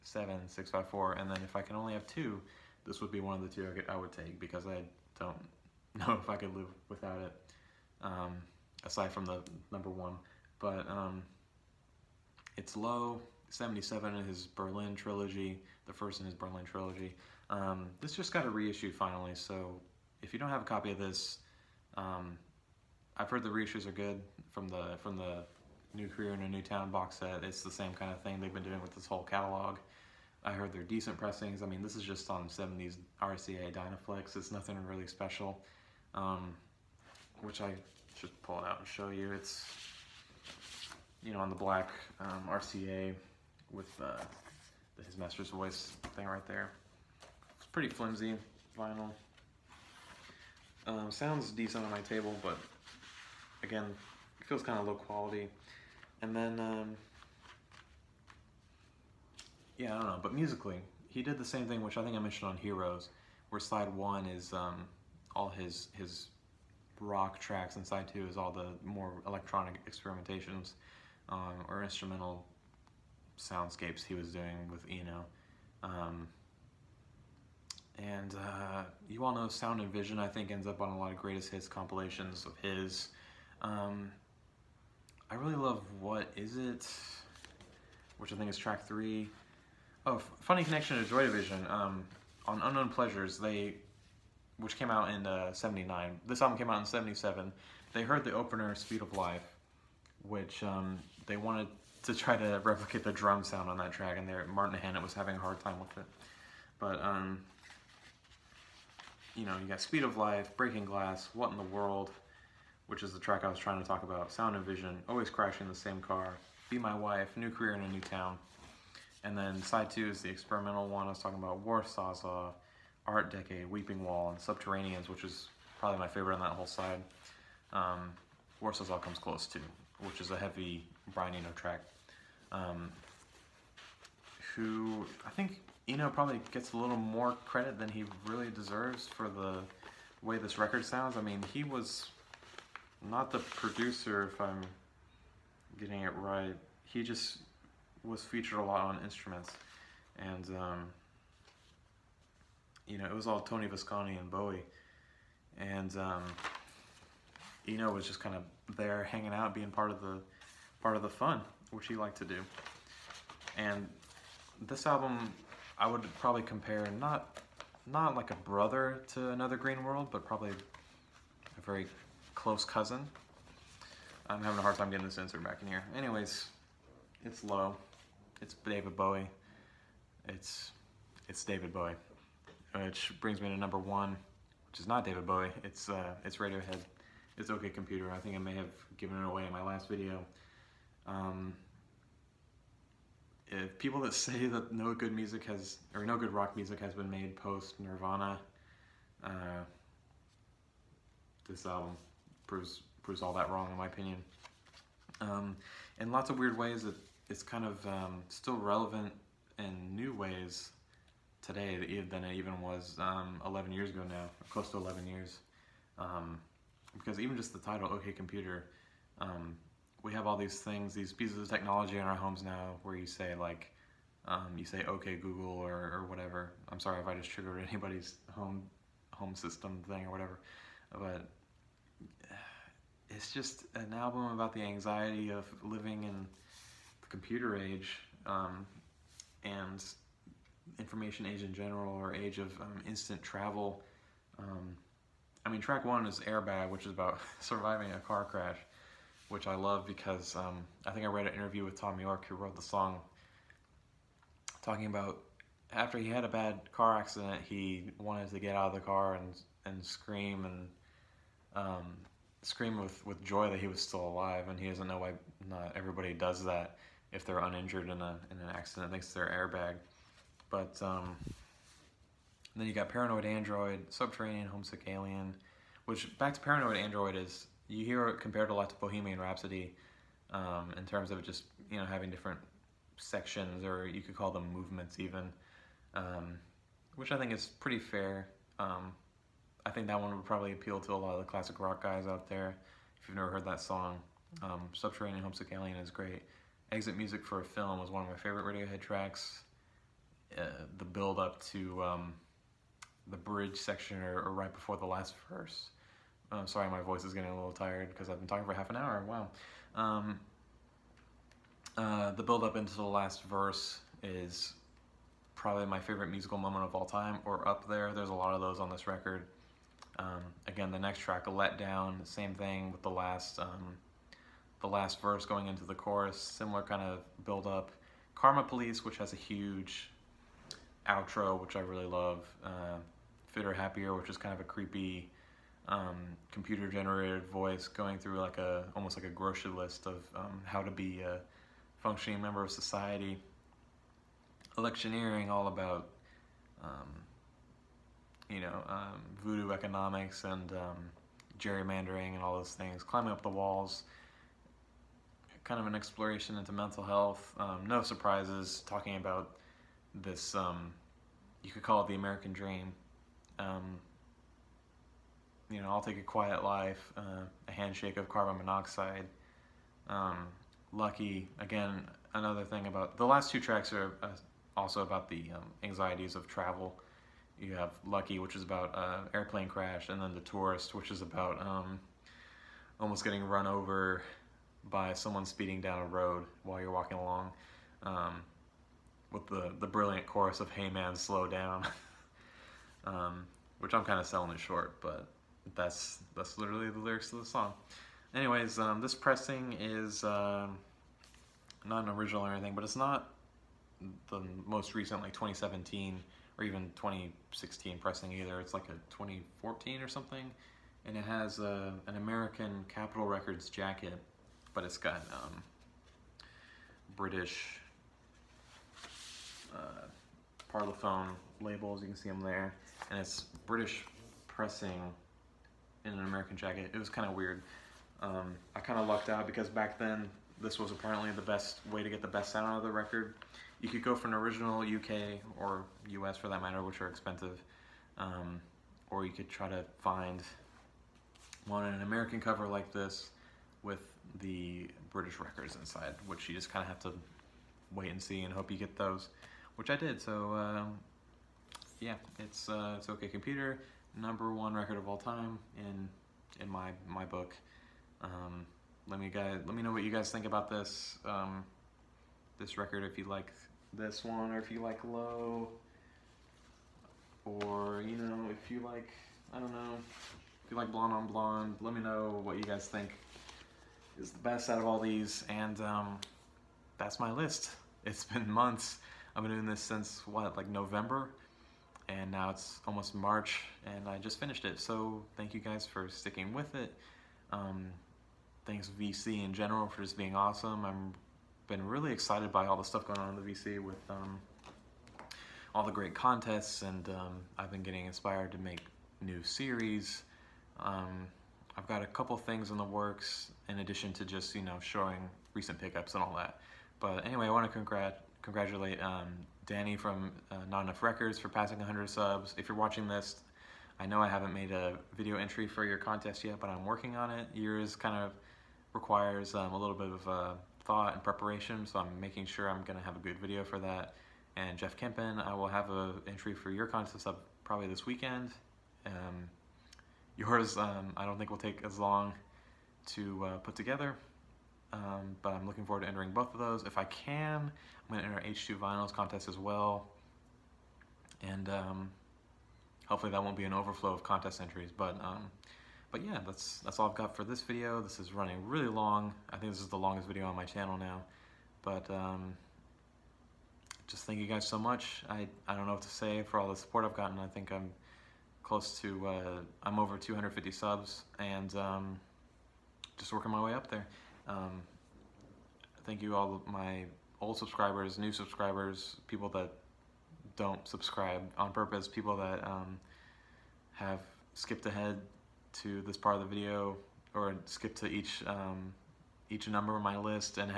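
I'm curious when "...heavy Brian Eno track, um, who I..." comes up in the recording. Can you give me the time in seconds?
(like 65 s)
130 s.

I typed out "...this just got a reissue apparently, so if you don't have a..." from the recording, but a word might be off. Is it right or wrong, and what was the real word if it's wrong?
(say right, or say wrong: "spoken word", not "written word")
wrong: "finally", not "apparently".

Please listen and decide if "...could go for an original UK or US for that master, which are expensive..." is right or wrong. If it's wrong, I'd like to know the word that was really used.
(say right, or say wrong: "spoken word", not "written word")
wrong: "matter", not "master".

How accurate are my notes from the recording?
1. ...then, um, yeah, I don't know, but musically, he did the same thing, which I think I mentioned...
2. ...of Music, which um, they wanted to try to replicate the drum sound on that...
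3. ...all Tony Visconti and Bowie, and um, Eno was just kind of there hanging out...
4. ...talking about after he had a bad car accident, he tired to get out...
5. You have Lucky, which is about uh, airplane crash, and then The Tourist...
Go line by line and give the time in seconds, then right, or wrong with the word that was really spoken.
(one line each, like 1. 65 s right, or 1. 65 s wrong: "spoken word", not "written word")
1. 56 s right
2. 99 s wrong: "Life", not "Music"
3. 153 s right
4. 254 s wrong: "wanted", not "tired"
5. 377 s right.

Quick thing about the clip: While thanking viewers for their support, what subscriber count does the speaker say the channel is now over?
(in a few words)
250.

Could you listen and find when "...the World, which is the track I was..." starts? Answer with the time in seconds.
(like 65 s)
111 s.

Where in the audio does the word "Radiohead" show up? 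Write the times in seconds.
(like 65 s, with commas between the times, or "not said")
186 s, 298 s.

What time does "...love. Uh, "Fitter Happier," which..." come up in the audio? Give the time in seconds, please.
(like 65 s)
331 s.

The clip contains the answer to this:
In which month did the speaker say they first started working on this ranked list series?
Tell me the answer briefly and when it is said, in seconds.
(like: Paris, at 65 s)
November, at 480 s.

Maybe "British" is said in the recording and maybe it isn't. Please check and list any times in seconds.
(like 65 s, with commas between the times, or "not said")
416 s, 423 s, 444 s.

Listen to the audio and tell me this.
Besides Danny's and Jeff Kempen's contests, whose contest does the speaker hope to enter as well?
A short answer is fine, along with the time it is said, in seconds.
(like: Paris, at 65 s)
H2 Vinyls, at 538 s.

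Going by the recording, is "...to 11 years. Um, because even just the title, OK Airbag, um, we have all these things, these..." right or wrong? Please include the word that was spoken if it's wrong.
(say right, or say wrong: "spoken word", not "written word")
wrong: "Computer", not "Airbag".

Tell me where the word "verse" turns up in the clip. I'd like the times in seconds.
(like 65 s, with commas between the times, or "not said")
305 s, 313 s, 325 s.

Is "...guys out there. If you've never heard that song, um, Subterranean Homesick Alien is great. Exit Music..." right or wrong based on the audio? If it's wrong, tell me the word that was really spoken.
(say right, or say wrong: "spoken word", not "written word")
right.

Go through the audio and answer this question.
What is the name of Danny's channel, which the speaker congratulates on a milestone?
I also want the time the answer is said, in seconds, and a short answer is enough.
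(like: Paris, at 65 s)
Not Enough Records, at 510 s.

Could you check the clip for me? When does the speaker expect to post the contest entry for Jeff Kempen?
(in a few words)
this weekend.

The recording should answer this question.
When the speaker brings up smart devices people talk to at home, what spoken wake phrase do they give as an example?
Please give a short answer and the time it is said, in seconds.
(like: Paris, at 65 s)
okay Google, at 224 s.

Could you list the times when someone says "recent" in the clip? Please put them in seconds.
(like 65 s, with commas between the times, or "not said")
404 s, 505 s.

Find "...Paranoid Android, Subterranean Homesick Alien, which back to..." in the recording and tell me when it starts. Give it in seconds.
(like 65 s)
272 s.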